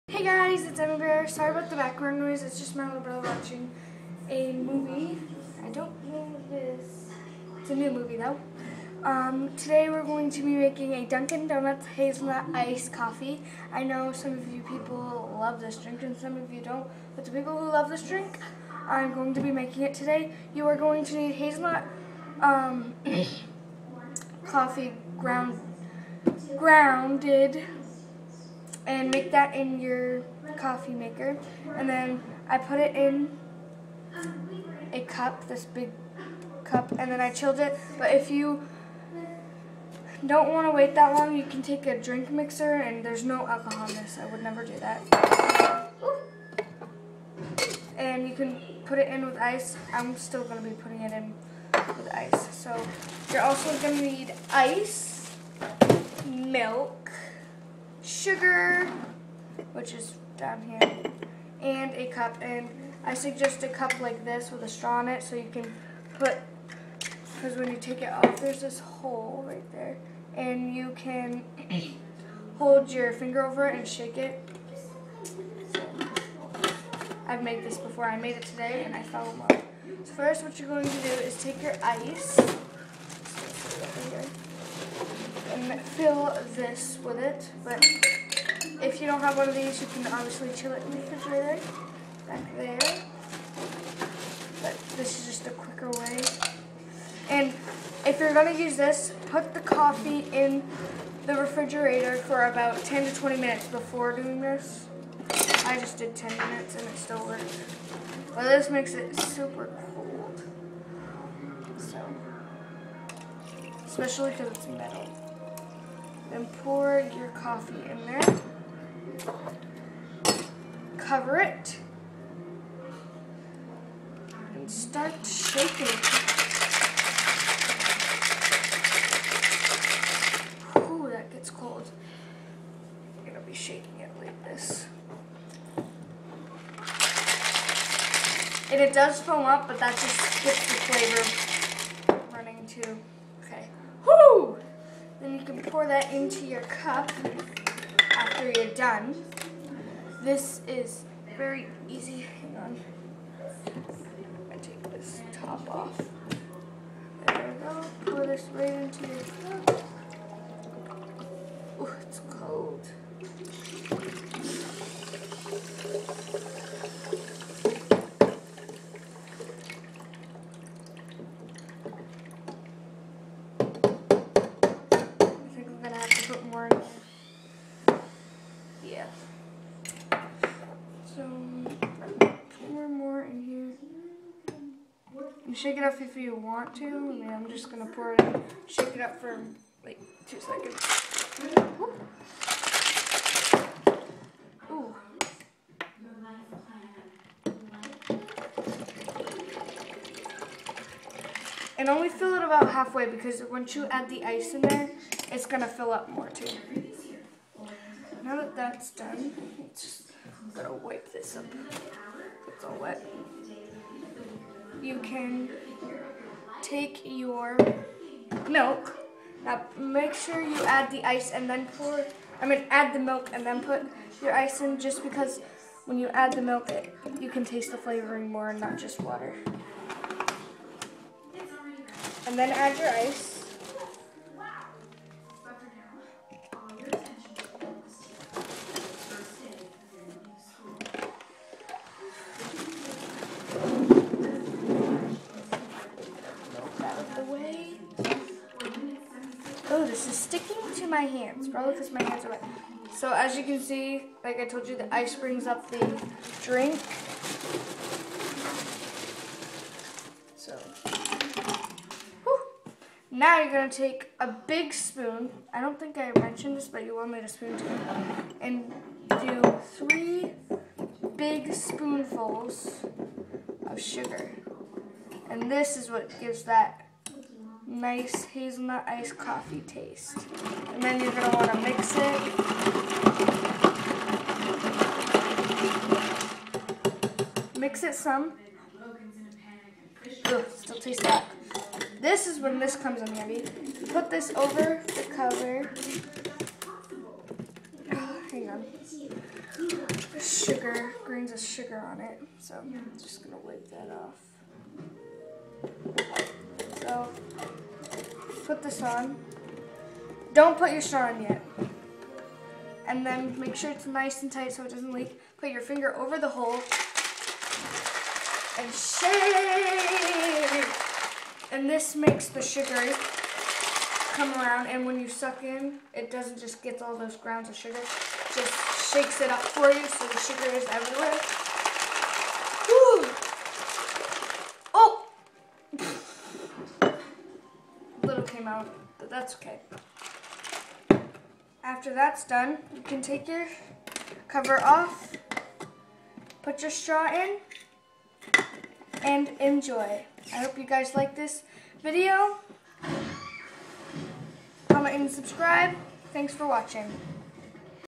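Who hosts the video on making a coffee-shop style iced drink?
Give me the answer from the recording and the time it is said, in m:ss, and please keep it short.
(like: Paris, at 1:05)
Emma Bear, at 0:00.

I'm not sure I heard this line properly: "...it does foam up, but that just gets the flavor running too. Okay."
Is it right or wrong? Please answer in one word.
right.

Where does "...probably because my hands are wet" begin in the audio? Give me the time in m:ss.
4:11.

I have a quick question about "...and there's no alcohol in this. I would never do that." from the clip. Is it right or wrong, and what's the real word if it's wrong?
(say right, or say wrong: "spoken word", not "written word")
right.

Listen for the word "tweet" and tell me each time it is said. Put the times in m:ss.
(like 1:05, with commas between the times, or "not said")
not said.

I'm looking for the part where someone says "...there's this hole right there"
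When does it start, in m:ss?
1:08.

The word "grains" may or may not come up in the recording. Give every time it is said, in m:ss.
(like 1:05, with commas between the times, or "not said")
5:01.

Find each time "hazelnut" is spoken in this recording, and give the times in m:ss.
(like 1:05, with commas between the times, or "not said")
0:11, 0:21, 4:38.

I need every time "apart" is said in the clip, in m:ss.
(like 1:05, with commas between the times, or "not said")
not said.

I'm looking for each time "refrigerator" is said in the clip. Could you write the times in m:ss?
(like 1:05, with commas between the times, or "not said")
1:30, 1:41.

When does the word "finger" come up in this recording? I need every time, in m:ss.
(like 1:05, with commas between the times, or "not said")
1:13, 5:15.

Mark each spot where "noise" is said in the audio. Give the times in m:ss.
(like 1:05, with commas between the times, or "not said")
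0:02.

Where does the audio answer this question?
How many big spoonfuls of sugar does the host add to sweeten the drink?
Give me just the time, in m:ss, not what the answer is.
4:29.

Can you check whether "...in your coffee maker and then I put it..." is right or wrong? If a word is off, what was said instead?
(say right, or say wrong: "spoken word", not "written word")
right.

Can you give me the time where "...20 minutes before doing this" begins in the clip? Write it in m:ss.
1:43.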